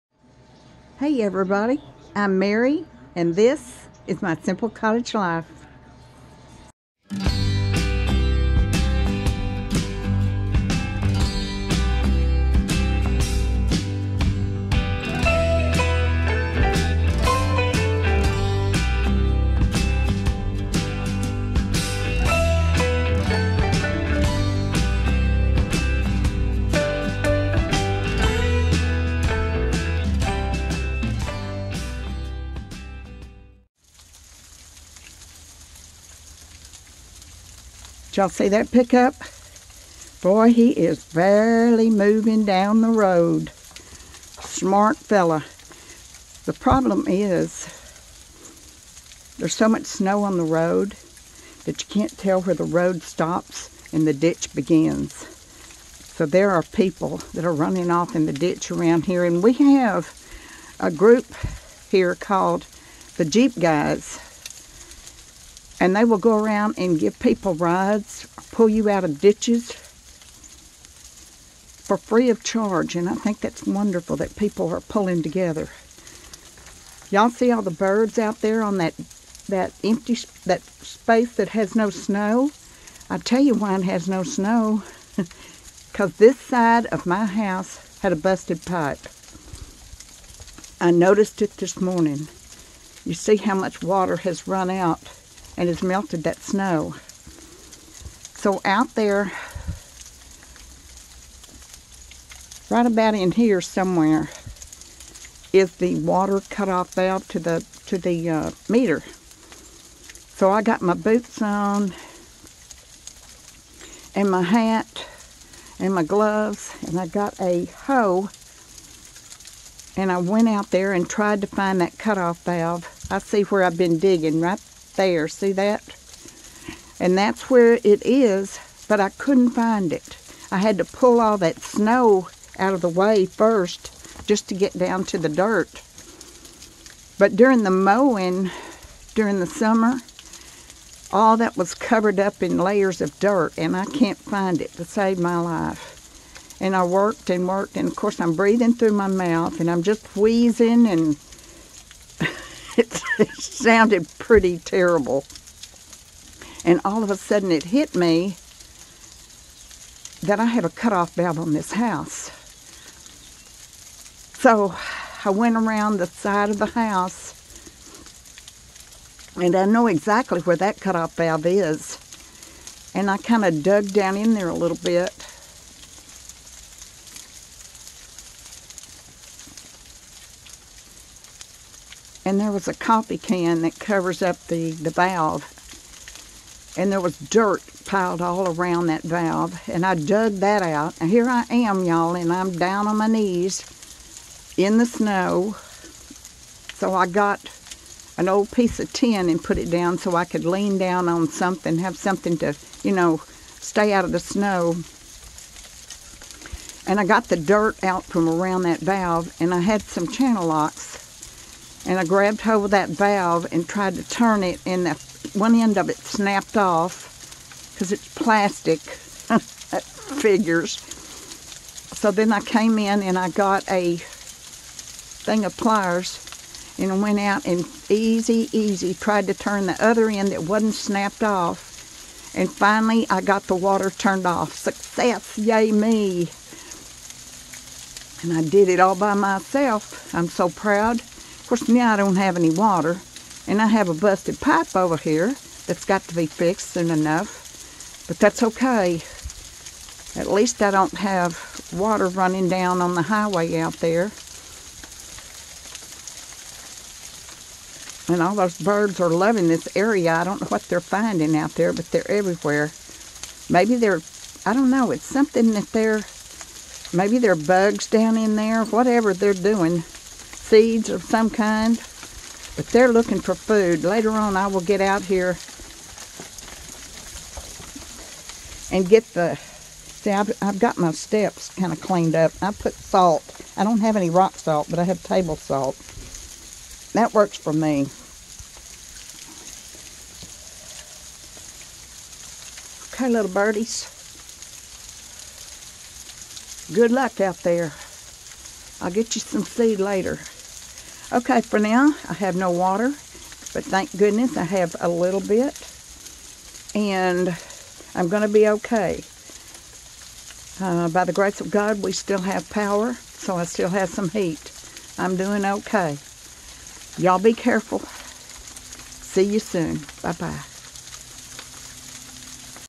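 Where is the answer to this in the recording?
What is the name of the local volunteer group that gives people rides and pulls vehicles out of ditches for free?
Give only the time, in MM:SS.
01:03.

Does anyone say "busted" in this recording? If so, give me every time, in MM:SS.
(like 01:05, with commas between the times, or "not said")
01:28, 04:03.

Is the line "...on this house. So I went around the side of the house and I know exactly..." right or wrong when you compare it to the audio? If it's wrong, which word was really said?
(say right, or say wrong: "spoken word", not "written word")
right.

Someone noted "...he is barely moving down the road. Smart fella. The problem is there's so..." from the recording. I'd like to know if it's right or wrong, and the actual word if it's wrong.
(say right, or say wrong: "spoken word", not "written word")
right.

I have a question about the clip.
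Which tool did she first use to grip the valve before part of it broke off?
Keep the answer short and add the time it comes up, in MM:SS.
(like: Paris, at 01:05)
Channel locks, at 03:30.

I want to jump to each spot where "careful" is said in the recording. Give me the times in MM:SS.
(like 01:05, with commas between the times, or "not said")
05:17.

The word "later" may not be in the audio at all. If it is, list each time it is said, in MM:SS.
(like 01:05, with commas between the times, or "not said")
04:33, 04:59.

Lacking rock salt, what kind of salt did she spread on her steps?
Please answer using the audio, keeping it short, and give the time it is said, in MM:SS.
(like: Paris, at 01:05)
Table salt, at 04:45.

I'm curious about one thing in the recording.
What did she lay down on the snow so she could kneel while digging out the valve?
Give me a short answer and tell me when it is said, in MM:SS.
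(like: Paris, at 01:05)
Piece of tin, at 03:18.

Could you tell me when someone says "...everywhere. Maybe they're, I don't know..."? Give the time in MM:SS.
04:22.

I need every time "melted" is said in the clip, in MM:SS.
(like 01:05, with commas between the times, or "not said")
01:35.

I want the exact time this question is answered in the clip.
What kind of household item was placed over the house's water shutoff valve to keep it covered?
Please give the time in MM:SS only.
03:02.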